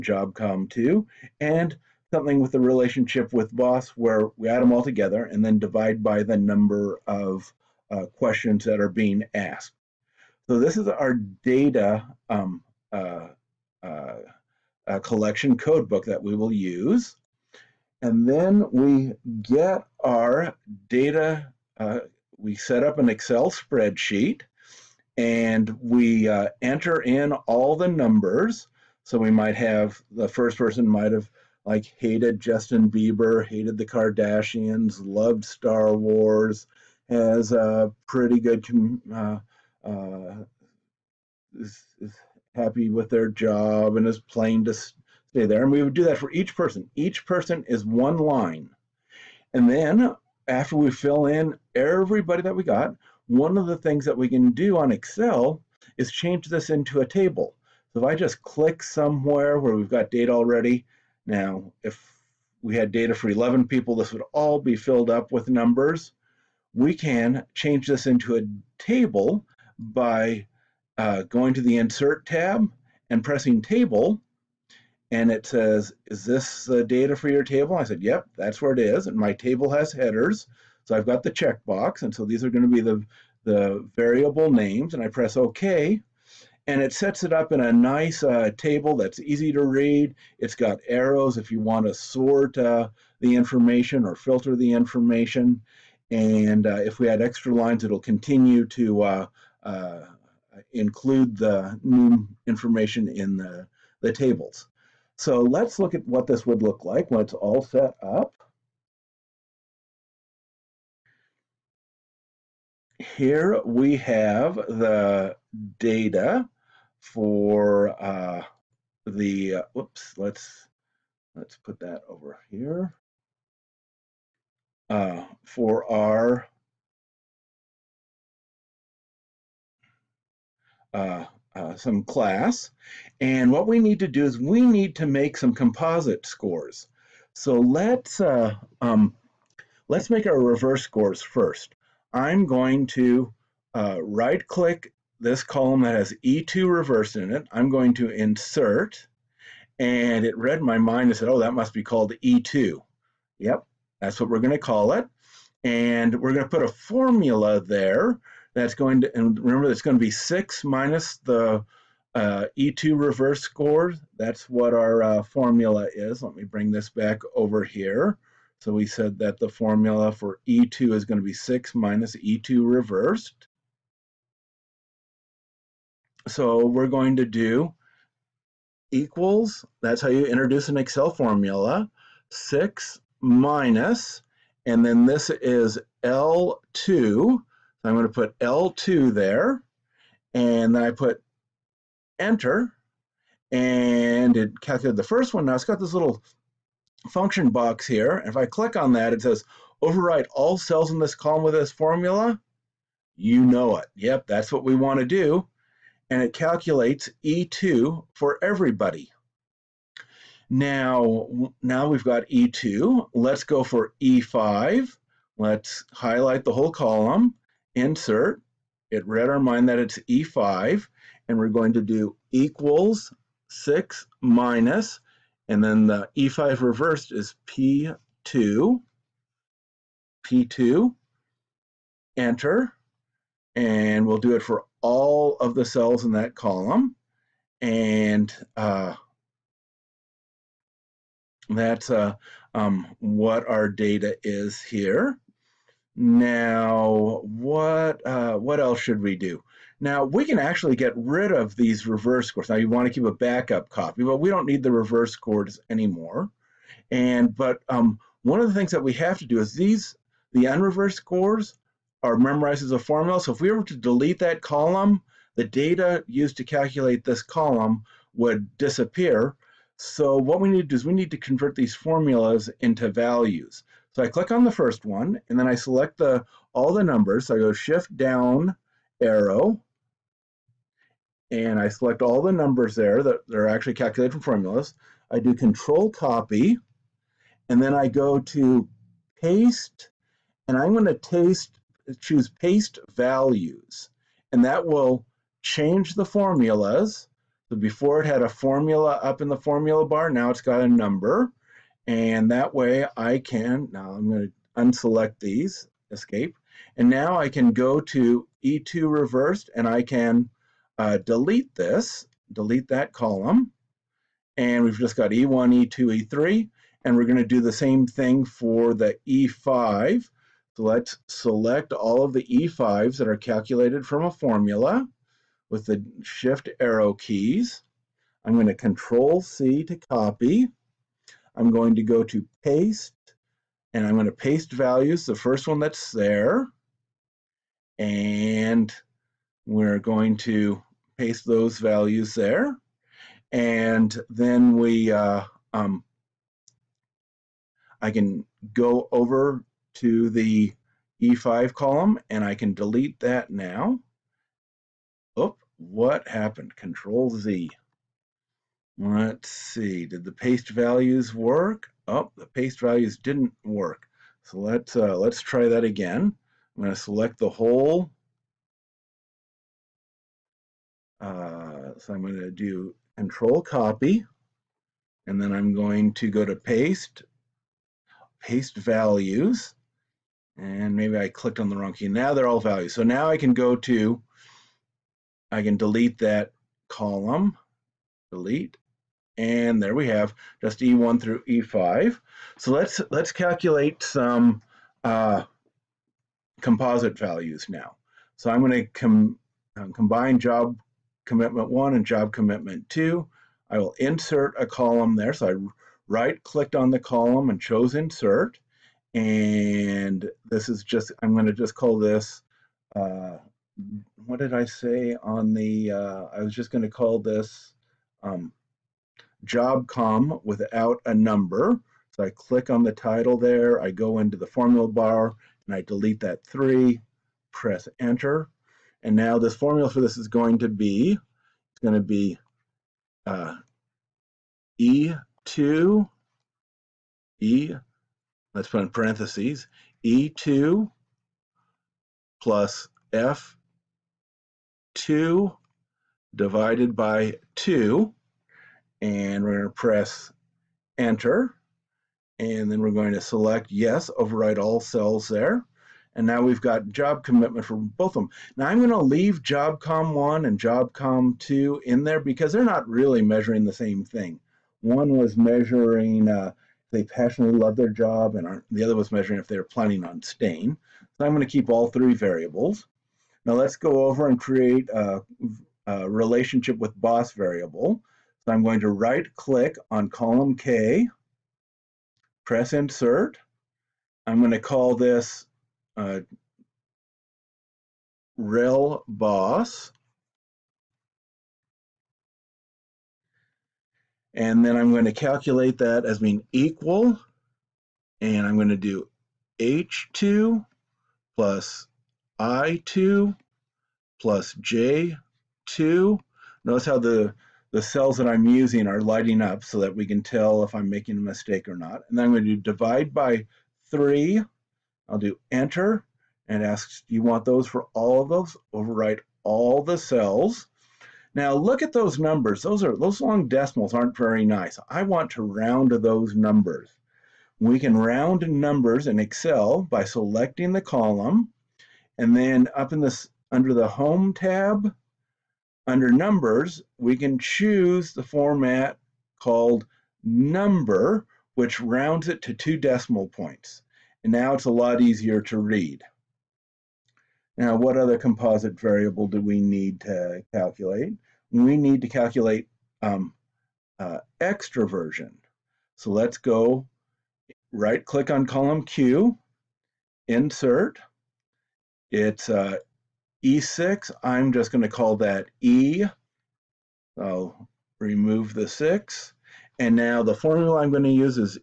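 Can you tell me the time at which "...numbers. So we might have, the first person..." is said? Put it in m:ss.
0:27.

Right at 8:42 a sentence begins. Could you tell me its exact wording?
Those are those long decimals aren't very nice.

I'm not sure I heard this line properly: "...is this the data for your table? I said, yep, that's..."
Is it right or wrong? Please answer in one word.
right.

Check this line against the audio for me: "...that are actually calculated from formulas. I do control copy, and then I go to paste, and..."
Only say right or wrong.
right.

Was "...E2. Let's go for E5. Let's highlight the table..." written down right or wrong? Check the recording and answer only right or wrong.
wrong.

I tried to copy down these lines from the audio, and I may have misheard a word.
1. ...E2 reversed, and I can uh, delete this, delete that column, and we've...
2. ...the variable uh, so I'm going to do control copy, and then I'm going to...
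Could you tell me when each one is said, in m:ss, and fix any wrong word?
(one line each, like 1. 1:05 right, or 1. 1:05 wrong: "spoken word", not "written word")
1. 5:08 right
2. 6:07 wrong: "whole", not "variable".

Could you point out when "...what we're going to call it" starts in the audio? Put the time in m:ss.
2:34.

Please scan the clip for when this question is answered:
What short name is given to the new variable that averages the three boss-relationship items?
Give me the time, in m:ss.
8:08.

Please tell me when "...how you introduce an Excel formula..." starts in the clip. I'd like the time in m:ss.
3:00.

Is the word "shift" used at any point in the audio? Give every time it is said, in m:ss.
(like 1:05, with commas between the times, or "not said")
4:37, 5:26.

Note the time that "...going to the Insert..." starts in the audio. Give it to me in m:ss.
1:11.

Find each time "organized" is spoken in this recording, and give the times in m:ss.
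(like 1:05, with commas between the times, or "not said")
not said.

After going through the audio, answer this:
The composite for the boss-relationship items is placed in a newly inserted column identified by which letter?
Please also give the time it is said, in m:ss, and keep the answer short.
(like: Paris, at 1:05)
K, at 7:59.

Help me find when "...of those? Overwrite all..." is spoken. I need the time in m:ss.
8:38.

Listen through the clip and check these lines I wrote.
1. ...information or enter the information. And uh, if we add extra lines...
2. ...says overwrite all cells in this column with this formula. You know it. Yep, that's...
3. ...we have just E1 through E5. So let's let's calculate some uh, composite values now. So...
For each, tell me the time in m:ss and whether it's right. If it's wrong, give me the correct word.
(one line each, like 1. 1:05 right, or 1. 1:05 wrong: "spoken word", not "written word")
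1. 1:33 wrong: "filter", not "enter"
2. 3:19 right
3. 6:29 right.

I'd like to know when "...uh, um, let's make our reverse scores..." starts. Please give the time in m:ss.
2:18.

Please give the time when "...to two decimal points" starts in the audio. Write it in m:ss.
9:02.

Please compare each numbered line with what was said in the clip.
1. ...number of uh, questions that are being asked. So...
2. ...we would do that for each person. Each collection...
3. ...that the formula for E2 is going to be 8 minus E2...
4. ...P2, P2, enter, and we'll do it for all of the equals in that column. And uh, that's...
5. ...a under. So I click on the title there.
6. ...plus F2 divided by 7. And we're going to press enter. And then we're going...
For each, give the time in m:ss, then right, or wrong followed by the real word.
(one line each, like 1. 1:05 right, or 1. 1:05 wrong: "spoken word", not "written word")
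1. 0:06 right
2. 0:45 wrong: "person", not "collection"
3. 2:49 wrong: "6", not "8"
4. 3:47 wrong: "cells", not "equals"
5. 7:00 wrong: "number", not "under"
6. 7:22 wrong: "2", not "7".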